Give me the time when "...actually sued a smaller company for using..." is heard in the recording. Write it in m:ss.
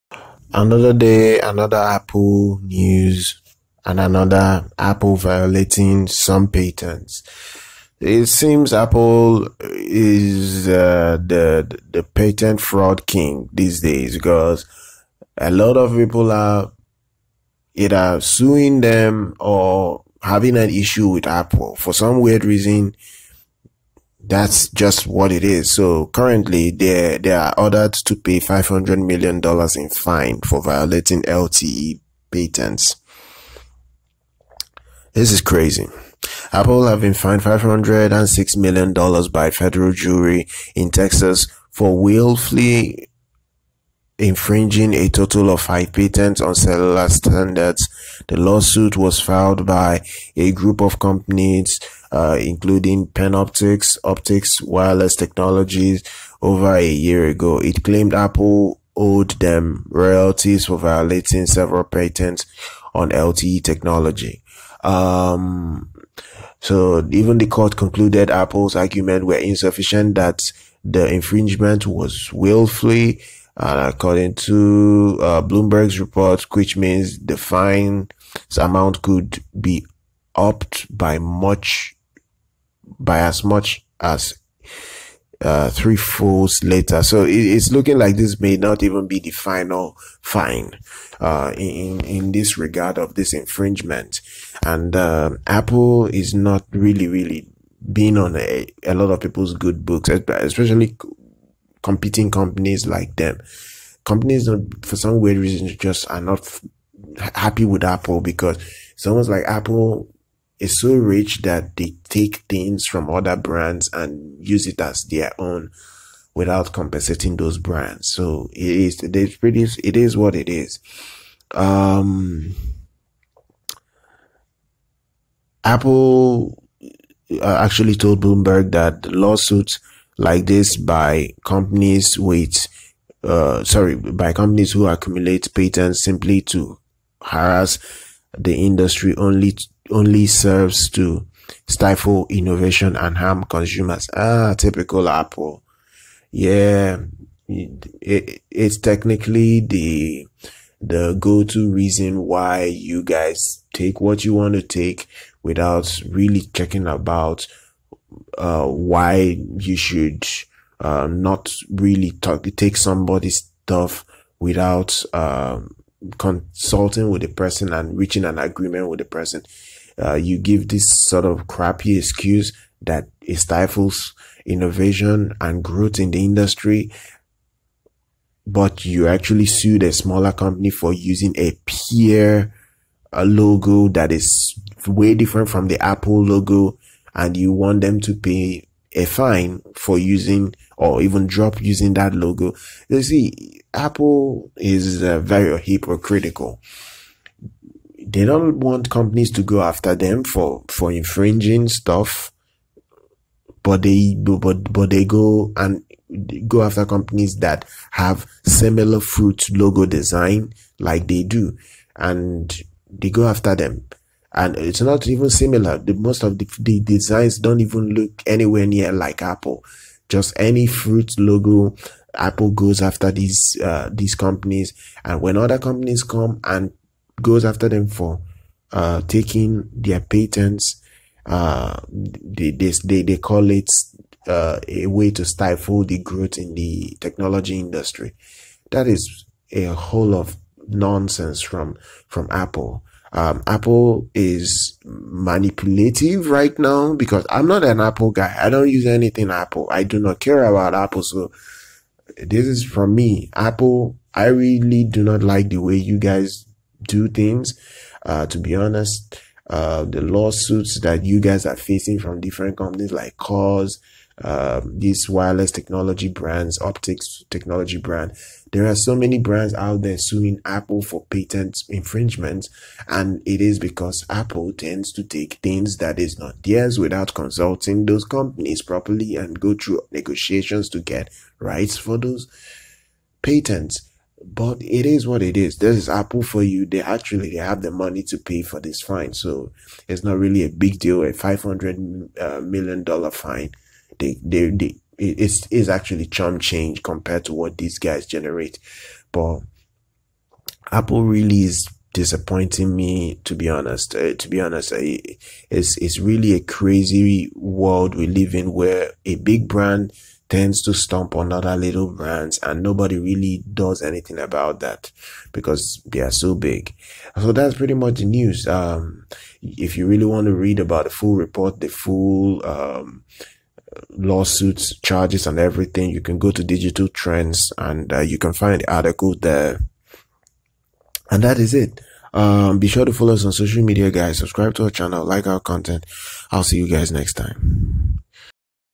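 2:59.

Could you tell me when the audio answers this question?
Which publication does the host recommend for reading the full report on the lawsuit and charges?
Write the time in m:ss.
5:26.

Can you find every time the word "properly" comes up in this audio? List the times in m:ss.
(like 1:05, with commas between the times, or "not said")
4:38.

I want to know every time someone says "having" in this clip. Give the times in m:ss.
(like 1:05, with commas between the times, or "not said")
0:20.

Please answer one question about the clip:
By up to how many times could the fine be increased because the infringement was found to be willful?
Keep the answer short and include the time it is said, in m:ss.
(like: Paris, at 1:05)
3, at 1:25.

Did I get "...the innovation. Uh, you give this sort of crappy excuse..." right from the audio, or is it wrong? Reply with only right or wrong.
wrong.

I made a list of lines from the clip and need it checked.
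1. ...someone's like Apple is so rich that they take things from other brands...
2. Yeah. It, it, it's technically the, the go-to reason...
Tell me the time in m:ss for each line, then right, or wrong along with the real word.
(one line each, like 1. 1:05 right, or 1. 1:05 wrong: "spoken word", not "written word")
1. 1:48 right
2. 2:26 right.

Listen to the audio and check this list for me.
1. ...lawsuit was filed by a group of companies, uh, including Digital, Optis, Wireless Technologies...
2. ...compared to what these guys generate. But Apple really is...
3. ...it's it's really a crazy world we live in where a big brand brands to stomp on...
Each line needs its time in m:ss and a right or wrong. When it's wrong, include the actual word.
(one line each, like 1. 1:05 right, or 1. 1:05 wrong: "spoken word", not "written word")
1. 0:48 wrong: "Panoptics", not "Digital"
2. 4:56 right
3. 5:05 wrong: "tends", not "brands".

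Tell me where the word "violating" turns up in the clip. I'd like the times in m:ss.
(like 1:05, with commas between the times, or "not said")
0:05, 0:30, 1:00.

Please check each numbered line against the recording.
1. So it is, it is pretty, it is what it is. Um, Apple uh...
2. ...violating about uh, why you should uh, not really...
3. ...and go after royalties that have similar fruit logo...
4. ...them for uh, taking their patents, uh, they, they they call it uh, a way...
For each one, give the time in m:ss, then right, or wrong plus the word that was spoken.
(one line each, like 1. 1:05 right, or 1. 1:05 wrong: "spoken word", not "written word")
1. 1:58 right
2. 2:36 wrong: "checking", not "violating"
3. 3:25 wrong: "companies", not "royalties"
4. 3:47 right.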